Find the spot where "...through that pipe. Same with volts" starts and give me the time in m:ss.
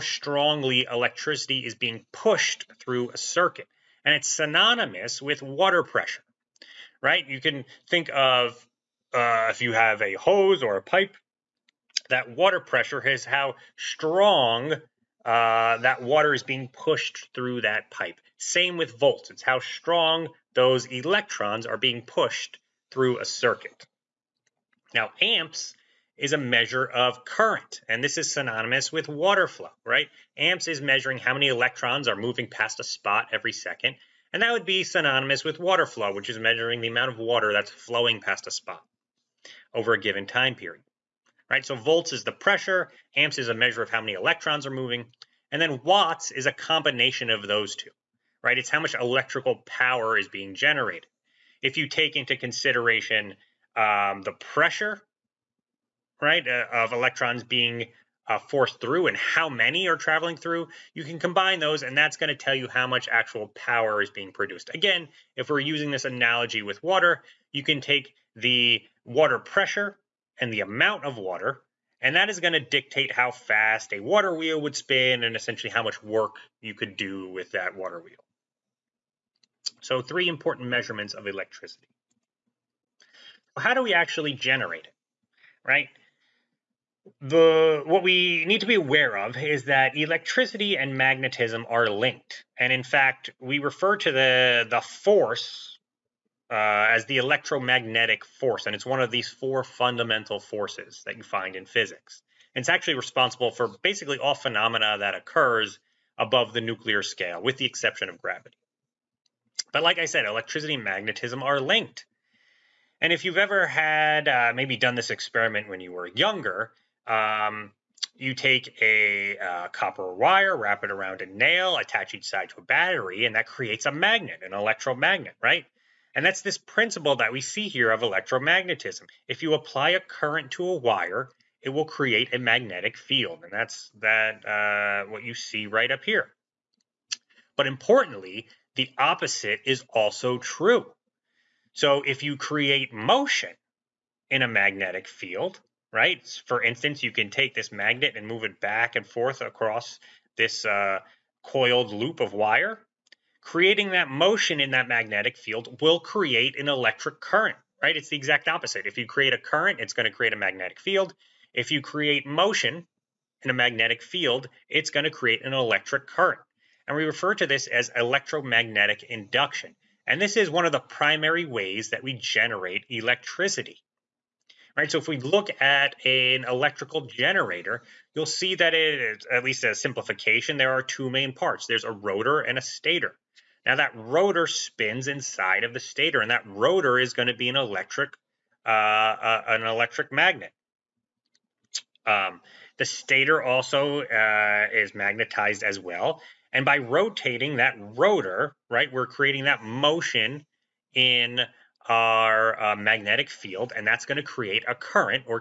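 0:17.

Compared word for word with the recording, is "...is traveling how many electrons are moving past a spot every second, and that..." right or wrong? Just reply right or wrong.
wrong.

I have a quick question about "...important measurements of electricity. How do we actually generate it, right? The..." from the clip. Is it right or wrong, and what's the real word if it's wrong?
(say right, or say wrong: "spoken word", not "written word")
right.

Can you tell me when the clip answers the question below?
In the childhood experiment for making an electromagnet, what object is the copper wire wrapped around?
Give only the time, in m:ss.
2:01.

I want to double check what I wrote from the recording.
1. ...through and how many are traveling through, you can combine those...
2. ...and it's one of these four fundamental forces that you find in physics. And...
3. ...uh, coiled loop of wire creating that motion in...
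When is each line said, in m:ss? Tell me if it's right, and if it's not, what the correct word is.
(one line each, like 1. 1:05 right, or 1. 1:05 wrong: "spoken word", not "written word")
1. 0:58 right
2. 1:38 right
3. 2:30 right.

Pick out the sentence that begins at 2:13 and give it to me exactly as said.
And that's that uh, what you see right up here.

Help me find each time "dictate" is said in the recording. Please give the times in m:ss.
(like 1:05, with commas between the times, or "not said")
1:12.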